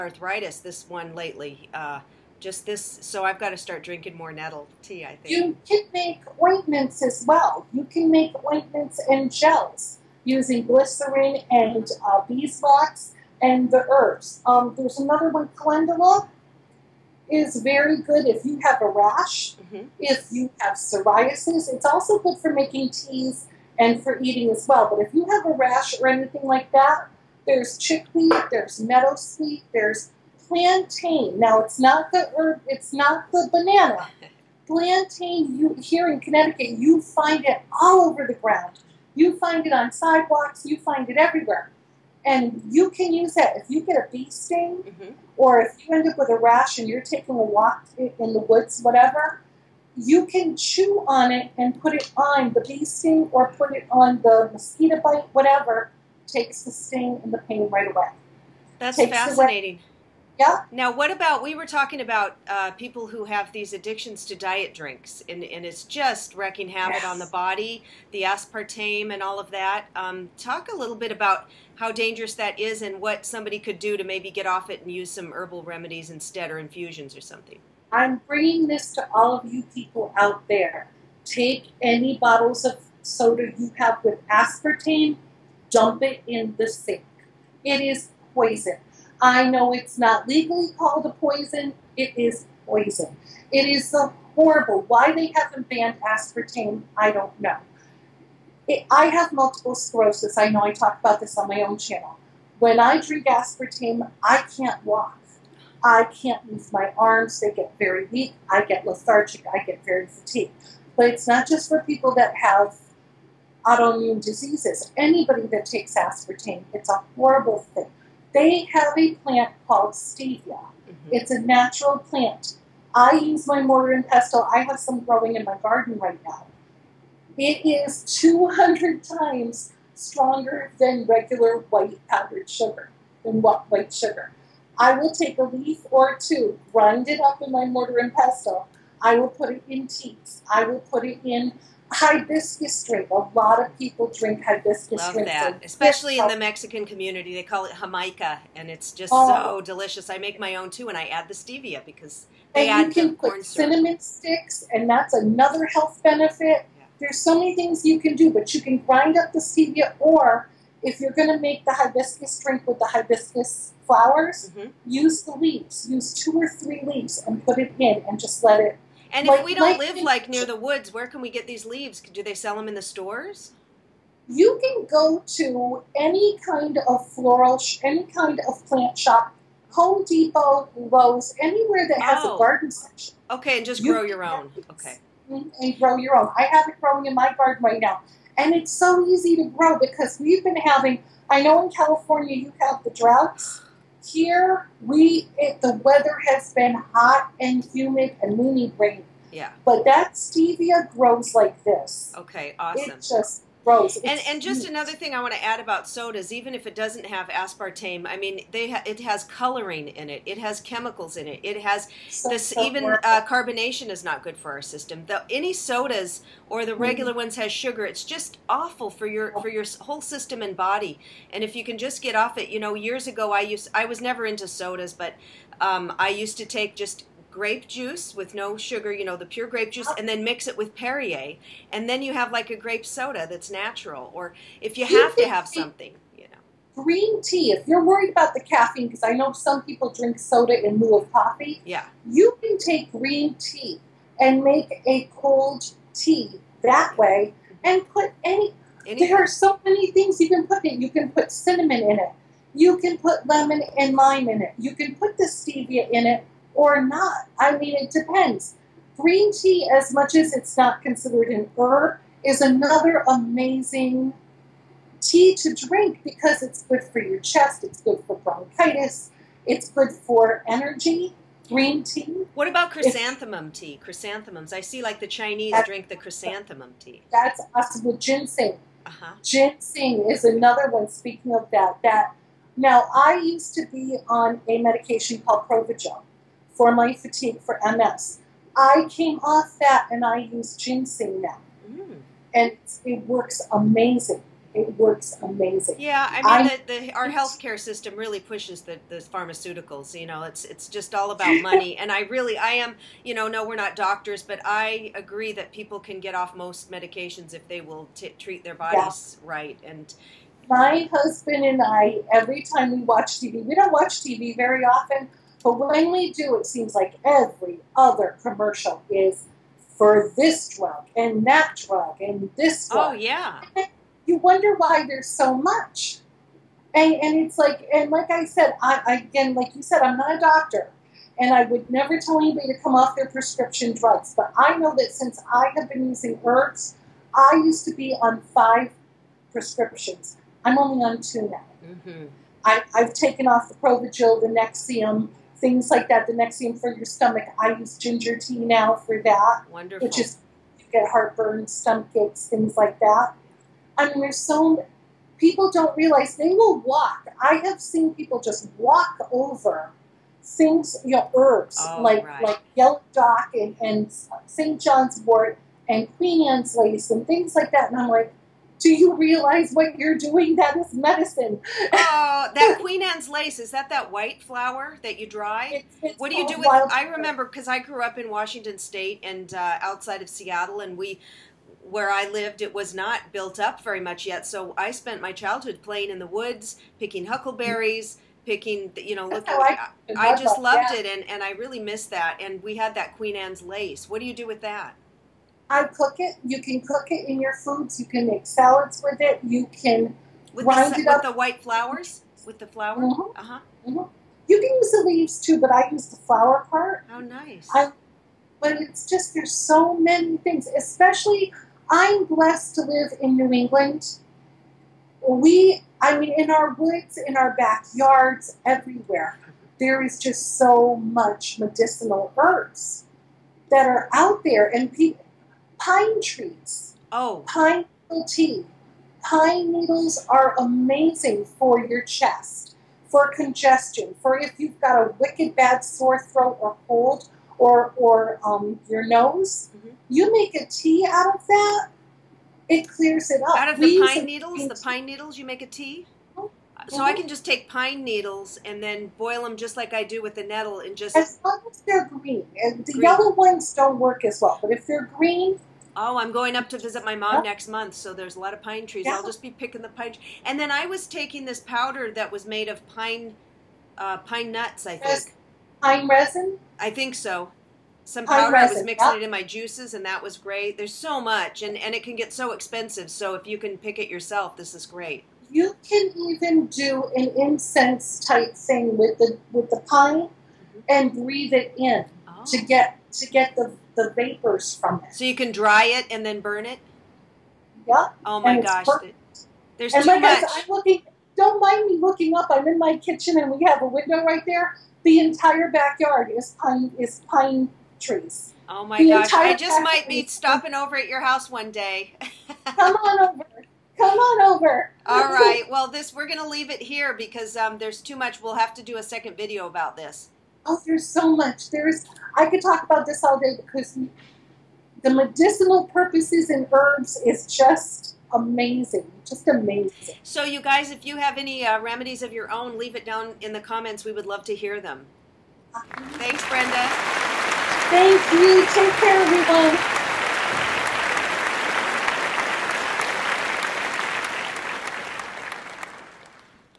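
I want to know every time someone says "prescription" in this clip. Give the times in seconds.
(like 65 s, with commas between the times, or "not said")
333 s, 339 s.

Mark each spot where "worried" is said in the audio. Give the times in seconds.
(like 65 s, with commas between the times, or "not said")
237 s.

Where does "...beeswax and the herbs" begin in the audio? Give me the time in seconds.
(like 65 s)
12 s.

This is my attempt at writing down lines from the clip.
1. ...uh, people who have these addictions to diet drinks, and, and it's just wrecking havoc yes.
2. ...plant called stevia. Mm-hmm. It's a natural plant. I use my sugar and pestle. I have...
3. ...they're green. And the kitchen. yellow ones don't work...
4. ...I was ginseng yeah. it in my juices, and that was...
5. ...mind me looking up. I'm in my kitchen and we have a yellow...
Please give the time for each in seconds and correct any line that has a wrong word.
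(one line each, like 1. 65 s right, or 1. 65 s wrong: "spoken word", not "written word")
1. 62 s right
2. 119 s wrong: "mortar", not "sugar"
3. 451 s wrong: "green", not "kitchen"
4. 468 s wrong: "mixing", not "ginseng"
5. 491 s wrong: "window", not "yellow".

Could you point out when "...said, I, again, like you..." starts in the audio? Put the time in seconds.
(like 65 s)
328 s.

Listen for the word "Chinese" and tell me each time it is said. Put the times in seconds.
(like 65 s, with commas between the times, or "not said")
275 s.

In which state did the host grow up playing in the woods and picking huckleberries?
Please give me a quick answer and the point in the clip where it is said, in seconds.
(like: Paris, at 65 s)
Washington State, at 378 s.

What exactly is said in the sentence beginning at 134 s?
I will take a leaf or two, grind it up in my mortar and pestle.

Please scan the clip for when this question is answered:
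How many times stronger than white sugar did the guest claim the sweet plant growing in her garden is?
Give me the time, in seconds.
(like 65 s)
128 s.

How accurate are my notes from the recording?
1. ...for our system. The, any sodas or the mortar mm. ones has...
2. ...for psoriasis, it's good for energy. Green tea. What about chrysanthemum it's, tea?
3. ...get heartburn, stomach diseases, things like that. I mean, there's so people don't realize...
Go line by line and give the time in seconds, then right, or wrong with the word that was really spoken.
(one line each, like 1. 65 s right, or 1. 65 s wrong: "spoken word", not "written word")
1. 214 s wrong: "regular", not "mortar"
2. 268 s wrong: "bronchitis", not "psoriasis"
3. 350 s wrong: "aches", not "diseases".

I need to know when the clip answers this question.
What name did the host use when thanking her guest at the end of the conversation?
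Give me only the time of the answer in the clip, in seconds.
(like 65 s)
526 s.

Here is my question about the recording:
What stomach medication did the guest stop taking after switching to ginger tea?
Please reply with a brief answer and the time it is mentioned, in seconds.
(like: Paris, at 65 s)
Nexium, at 344 s.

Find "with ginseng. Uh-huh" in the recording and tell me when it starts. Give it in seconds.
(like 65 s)
277 s.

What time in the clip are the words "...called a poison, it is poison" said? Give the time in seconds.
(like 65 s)
90 s.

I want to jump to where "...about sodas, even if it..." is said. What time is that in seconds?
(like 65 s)
205 s.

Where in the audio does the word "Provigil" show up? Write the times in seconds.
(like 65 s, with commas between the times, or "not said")
285 s, 343 s.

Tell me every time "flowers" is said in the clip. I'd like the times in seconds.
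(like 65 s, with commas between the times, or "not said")
163 s, 374 s, 401 s, 405 s.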